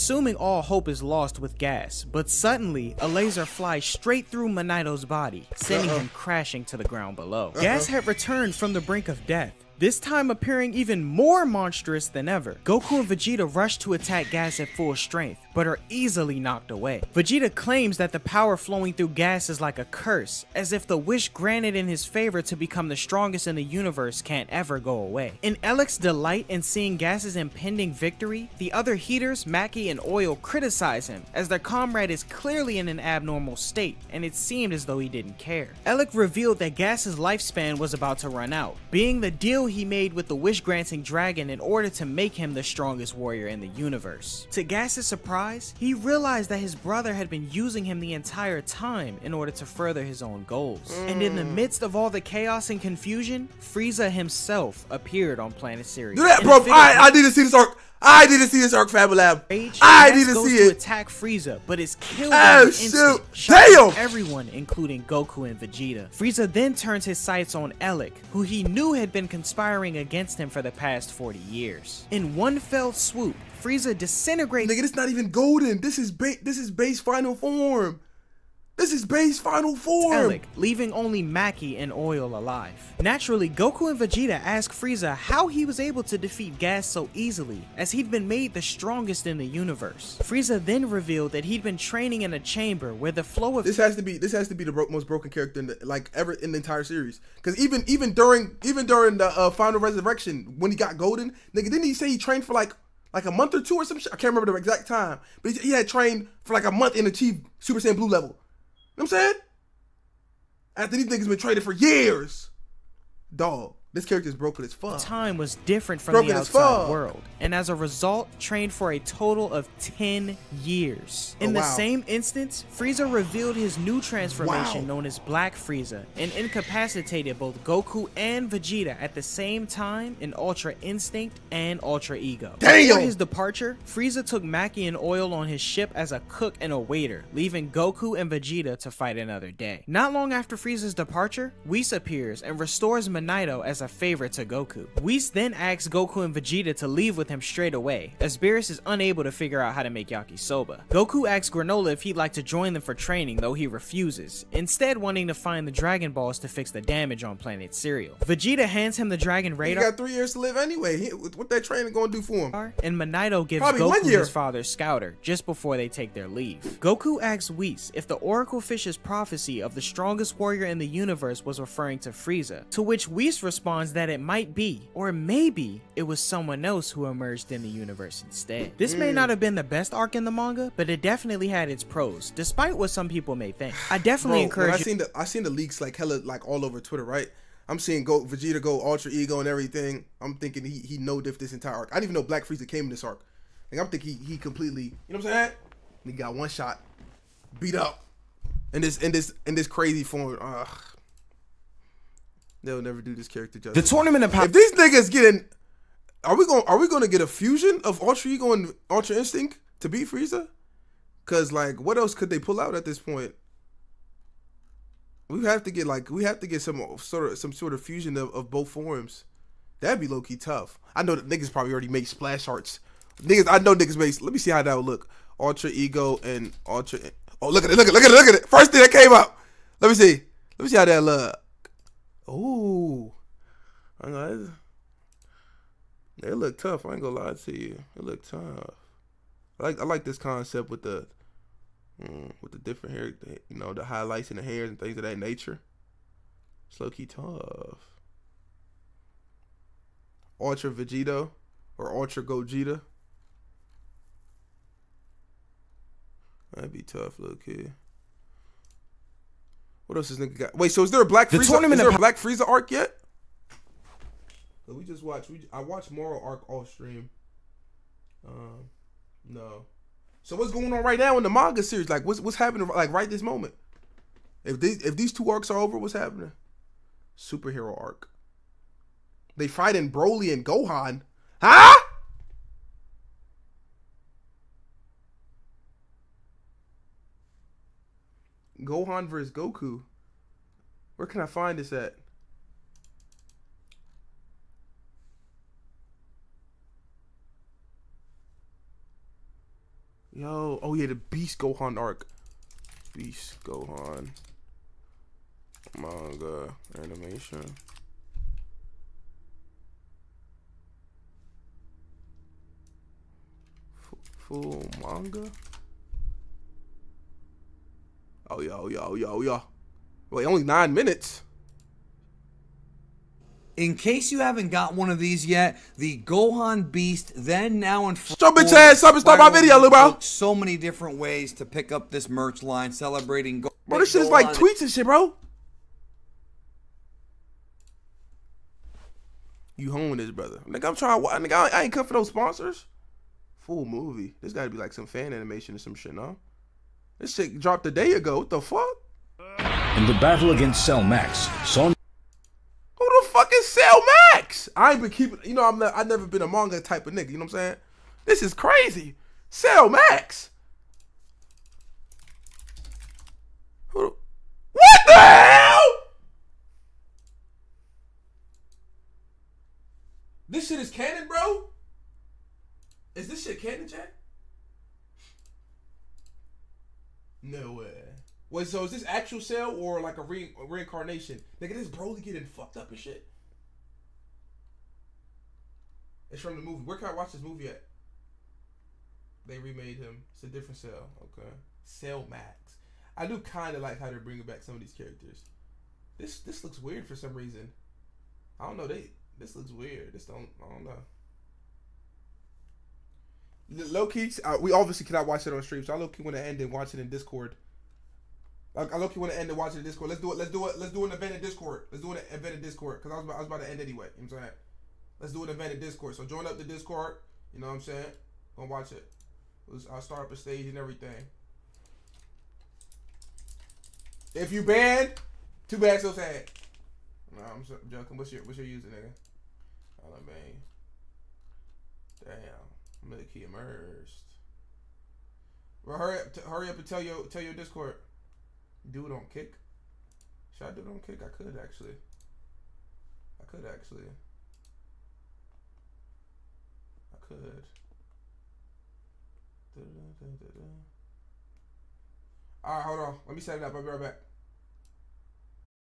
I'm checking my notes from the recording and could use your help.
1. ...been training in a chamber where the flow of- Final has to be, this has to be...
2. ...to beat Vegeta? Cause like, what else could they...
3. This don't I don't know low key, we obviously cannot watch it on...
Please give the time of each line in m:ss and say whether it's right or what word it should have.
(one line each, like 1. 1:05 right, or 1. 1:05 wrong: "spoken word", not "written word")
1. 1:31 wrong: "This", not "Final"
2. 3:29 wrong: "Frieza", not "Vegeta"
3. 6:39 right.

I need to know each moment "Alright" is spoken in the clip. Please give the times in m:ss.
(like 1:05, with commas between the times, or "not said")
7:32.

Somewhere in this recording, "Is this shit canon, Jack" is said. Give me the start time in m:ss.
6:12.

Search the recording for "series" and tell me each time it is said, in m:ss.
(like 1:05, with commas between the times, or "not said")
1:36, 4:31.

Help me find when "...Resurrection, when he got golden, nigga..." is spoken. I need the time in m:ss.
1:39.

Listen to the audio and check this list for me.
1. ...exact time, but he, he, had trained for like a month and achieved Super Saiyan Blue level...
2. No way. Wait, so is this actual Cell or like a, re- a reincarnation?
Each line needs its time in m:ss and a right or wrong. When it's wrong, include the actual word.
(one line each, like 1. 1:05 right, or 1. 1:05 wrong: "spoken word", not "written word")
1. 1:44 right
2. 6:17 right.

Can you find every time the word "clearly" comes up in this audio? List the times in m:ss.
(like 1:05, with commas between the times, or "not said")
0:32.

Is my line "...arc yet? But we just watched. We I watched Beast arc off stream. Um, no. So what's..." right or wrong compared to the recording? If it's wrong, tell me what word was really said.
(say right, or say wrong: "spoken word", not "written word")
wrong: "Moro", not "Beast".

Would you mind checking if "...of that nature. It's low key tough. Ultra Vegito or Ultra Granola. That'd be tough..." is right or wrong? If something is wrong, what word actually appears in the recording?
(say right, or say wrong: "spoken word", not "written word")
wrong: "Gogeta", not "Granola".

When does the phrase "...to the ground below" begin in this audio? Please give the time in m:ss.
0:06.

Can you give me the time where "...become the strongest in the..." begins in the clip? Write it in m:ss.
0:22.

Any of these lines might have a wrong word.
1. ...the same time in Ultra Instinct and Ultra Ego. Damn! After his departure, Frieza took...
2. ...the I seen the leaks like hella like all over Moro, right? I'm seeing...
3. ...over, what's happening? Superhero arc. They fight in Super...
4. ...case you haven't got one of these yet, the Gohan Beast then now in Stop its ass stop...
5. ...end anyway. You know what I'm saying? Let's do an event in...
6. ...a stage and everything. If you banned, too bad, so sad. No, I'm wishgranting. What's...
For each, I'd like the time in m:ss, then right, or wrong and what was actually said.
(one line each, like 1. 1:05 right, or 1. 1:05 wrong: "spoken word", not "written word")
1. 2:09 right
2. 3:04 wrong: "Twitter", not "Moro"
3. 4:35 wrong: "Broly", not "Super"
4. 5:23 right
5. 6:53 right
6. 7:00 wrong: "joking", not "wishgranting".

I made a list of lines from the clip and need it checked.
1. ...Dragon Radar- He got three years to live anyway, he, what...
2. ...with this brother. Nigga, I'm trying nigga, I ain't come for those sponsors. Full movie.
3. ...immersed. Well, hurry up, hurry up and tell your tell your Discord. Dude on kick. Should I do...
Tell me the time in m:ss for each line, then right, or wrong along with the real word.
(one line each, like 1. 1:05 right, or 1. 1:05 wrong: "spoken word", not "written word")
1. 2:39 right
2. 5:39 right
3. 7:13 right.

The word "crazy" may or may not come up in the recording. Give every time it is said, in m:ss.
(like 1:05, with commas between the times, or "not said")
3:19, 5:58.